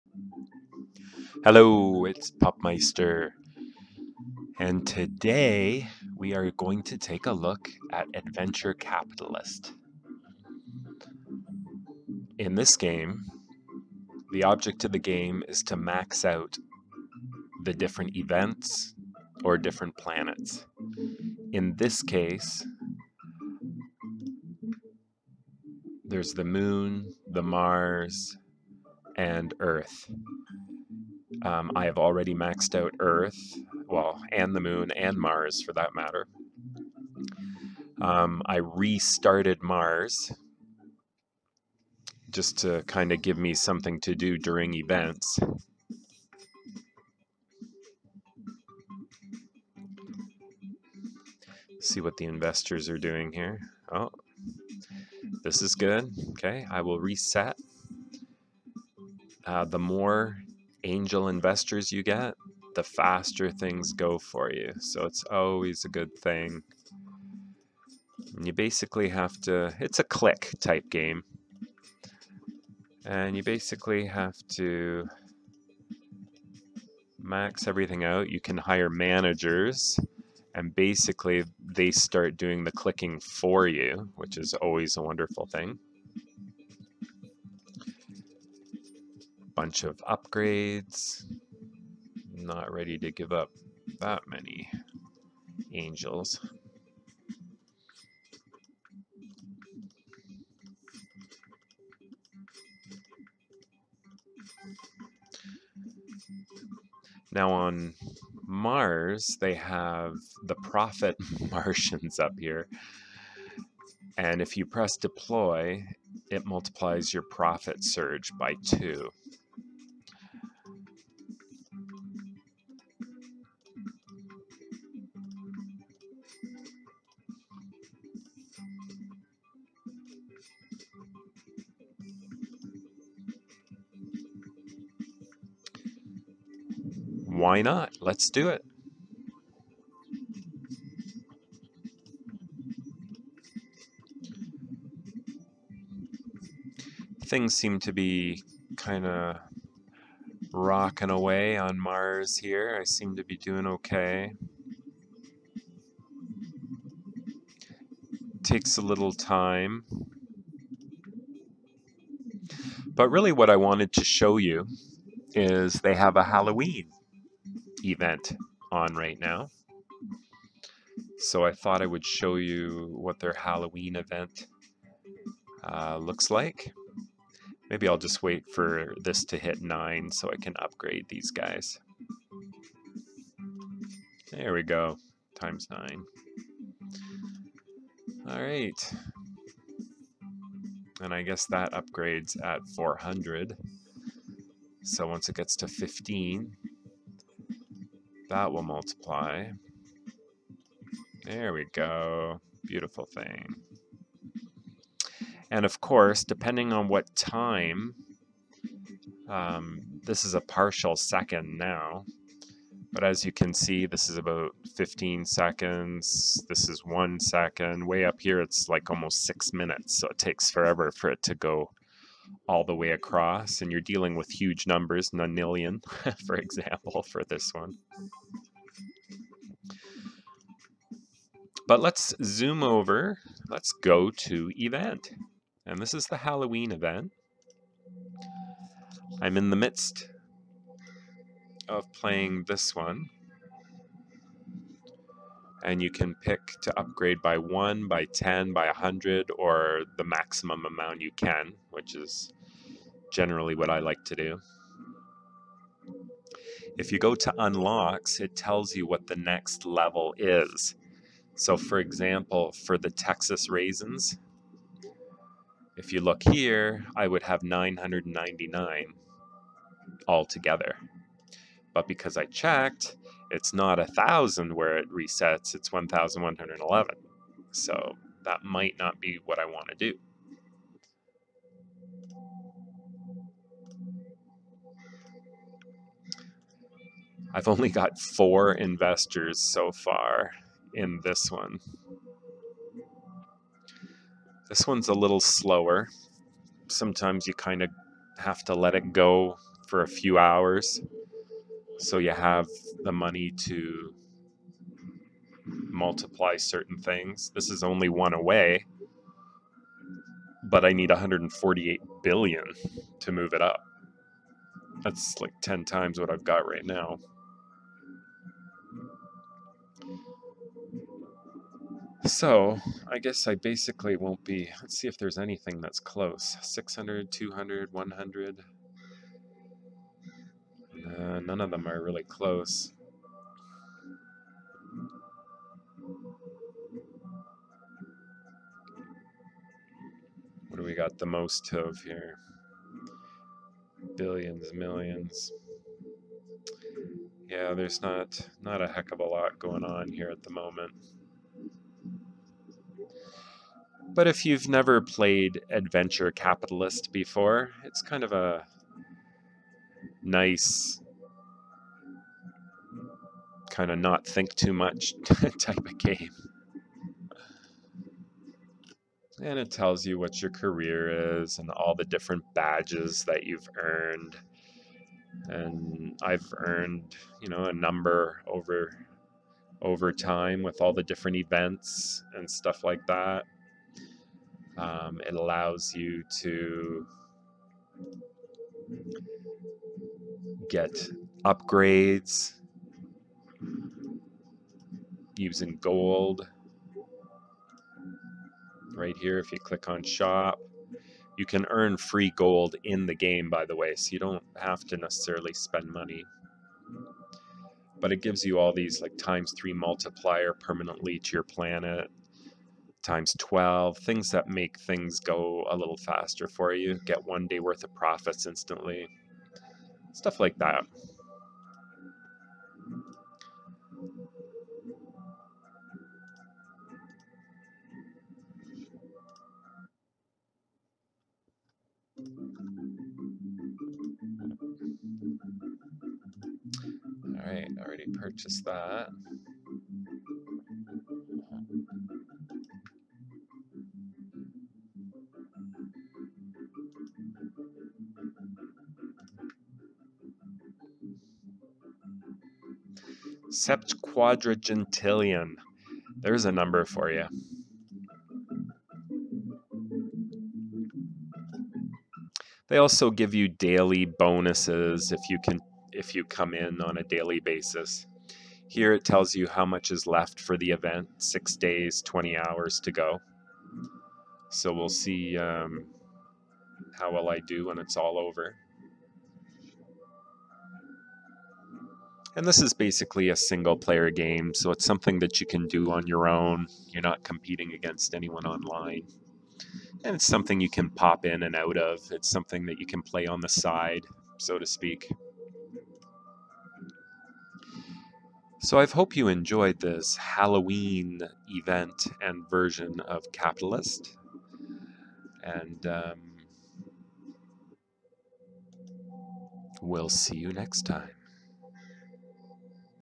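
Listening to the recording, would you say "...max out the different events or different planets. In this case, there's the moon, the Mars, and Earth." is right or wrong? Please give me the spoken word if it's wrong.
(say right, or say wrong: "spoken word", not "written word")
right.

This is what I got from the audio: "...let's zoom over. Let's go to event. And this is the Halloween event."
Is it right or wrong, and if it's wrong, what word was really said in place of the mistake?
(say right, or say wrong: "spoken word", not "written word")
right.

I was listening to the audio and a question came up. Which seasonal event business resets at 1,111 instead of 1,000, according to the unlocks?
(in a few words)
Texas raisins.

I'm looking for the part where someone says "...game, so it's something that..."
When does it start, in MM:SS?
08:03.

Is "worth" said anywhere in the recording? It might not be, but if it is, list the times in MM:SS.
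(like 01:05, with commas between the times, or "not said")
06:57.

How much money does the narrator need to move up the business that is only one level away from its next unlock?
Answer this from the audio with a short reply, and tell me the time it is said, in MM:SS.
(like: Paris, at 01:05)
148 billion, at 05:10.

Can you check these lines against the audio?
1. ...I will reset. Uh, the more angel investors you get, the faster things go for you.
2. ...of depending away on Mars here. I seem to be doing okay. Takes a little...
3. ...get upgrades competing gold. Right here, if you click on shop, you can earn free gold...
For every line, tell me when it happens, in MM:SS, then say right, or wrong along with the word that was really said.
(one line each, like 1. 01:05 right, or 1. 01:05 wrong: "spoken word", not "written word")
1. 00:56 right
2. 02:29 wrong: "rocking", not "depending"
3. 06:30 wrong: "using", not "competing".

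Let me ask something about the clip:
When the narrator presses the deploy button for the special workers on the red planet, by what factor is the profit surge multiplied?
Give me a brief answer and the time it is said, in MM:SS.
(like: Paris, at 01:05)
2, at 01:58.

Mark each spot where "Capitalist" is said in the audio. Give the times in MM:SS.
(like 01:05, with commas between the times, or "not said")
00:08, 05:56, 08:23.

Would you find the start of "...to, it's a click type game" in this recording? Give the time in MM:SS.
01:09.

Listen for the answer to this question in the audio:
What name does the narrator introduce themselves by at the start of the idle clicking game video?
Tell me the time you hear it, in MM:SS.
00:02.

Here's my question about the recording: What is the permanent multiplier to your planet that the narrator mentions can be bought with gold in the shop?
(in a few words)
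3.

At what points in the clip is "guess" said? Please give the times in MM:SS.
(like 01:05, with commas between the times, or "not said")
03:11, 05:22.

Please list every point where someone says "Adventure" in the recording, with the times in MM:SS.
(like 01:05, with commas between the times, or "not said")
00:08, 05:55.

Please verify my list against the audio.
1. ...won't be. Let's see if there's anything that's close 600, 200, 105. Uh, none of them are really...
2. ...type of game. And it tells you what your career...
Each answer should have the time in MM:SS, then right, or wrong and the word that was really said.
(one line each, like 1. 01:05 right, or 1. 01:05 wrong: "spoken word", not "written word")
1. 05:23 wrong: "100", not "105"
2. 06:05 right.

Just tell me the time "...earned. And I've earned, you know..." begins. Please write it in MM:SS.
06:13.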